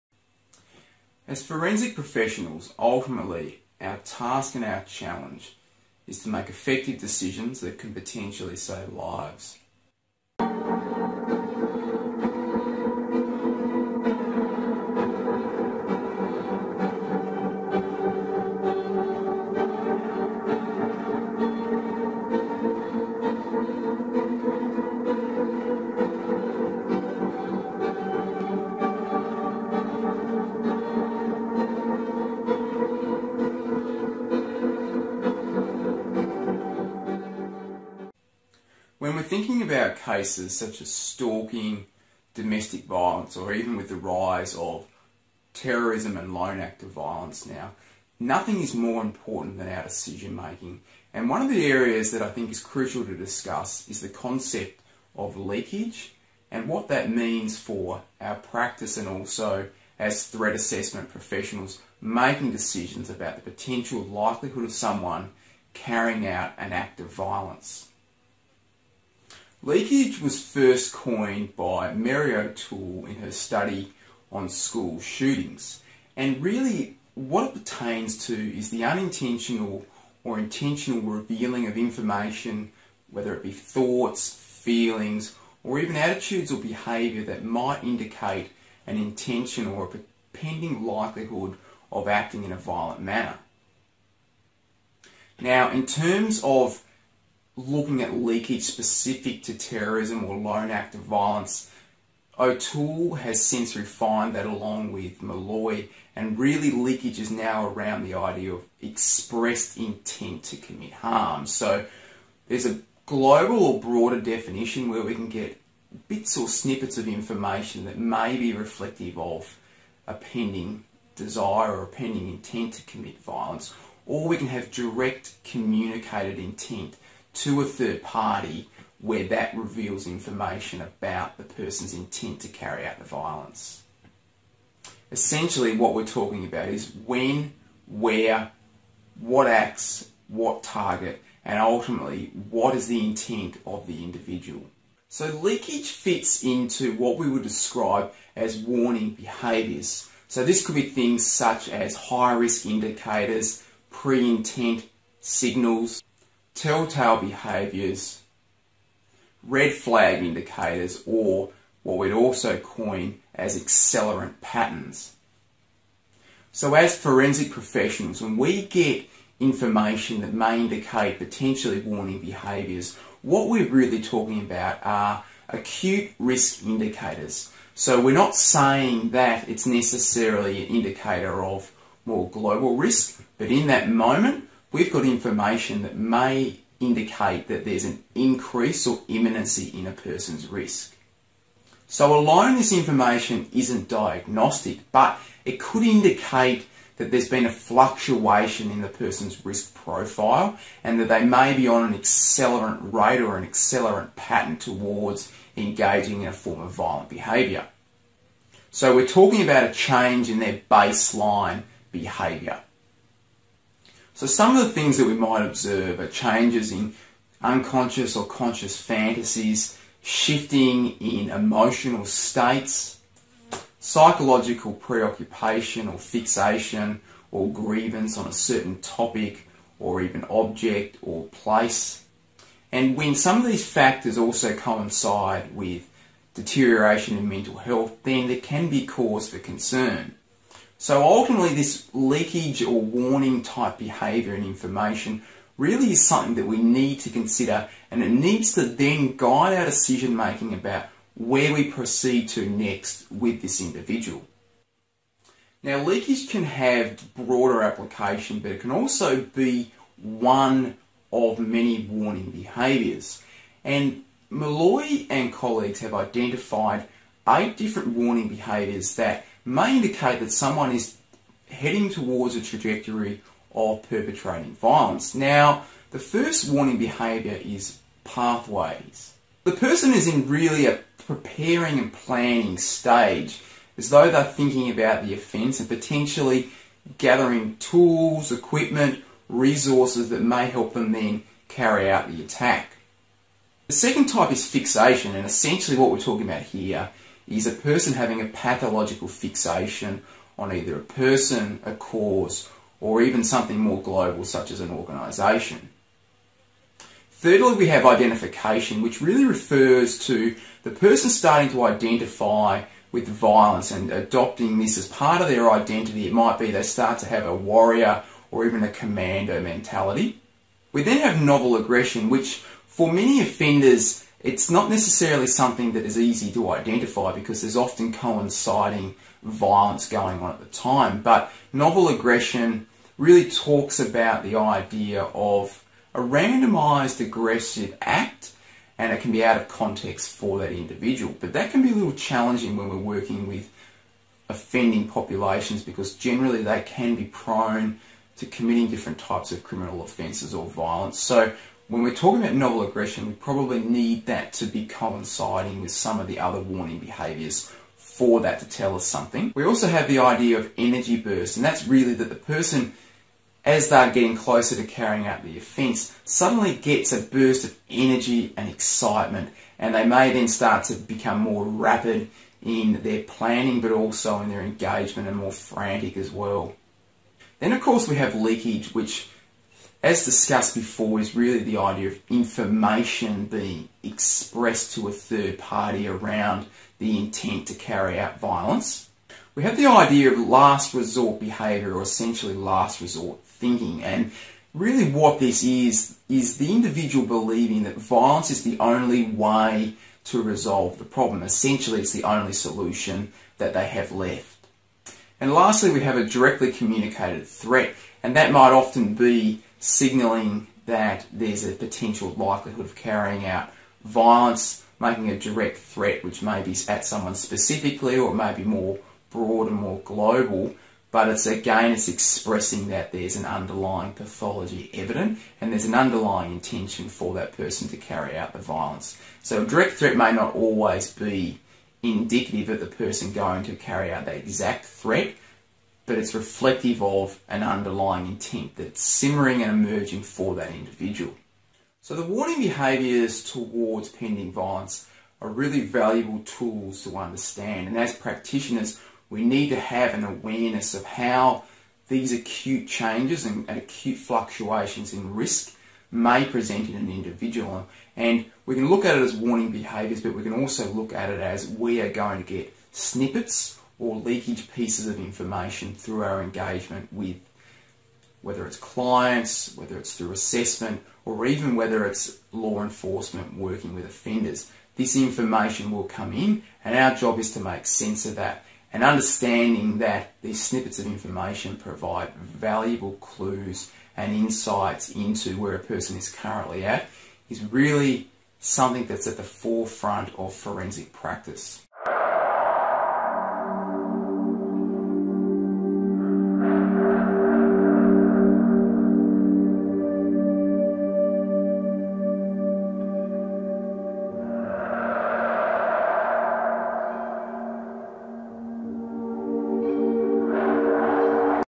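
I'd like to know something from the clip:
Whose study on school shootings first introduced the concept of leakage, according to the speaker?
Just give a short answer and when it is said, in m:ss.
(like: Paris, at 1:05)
Mary O'Toole, at 1:11.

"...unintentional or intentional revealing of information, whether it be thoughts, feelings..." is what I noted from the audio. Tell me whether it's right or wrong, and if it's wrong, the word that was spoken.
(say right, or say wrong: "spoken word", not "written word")
right.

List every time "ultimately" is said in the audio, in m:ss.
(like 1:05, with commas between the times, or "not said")
0:02, 2:21, 4:01.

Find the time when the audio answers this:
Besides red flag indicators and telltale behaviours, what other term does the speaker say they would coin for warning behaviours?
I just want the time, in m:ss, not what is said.
2:43.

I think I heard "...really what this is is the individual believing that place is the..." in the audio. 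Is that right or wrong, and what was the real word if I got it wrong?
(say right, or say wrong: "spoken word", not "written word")
wrong: "violence", not "place".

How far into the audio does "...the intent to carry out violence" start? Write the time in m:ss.
6:26.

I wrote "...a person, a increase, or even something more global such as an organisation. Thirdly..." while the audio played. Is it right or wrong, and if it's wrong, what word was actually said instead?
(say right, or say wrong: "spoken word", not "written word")
wrong: "cause", not "increase".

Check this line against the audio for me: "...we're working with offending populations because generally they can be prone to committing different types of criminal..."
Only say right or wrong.
right.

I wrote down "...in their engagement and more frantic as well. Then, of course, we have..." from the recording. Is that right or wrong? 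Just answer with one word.
right.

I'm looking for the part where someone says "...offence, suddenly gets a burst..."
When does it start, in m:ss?
6:05.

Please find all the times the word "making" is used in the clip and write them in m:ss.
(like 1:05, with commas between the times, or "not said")
0:50, 1:02, 4:10, 6:54.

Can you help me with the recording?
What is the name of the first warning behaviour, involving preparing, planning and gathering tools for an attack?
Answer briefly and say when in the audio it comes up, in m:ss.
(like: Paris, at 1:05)
pathways, at 4:38.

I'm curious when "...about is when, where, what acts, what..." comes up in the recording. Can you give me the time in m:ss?
2:16.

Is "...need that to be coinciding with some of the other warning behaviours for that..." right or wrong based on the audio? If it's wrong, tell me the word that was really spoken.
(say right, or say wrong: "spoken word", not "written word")
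right.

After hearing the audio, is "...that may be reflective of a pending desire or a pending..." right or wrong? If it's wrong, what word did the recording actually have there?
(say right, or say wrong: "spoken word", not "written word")
right.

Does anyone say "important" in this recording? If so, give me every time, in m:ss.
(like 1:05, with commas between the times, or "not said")
0:49.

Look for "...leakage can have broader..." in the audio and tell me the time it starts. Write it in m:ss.
4:15.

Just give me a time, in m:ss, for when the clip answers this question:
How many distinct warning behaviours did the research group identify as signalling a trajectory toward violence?
4:27.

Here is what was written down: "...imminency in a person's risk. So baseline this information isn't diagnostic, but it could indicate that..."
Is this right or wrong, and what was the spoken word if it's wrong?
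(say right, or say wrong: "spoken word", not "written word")
wrong: "alone", not "baseline".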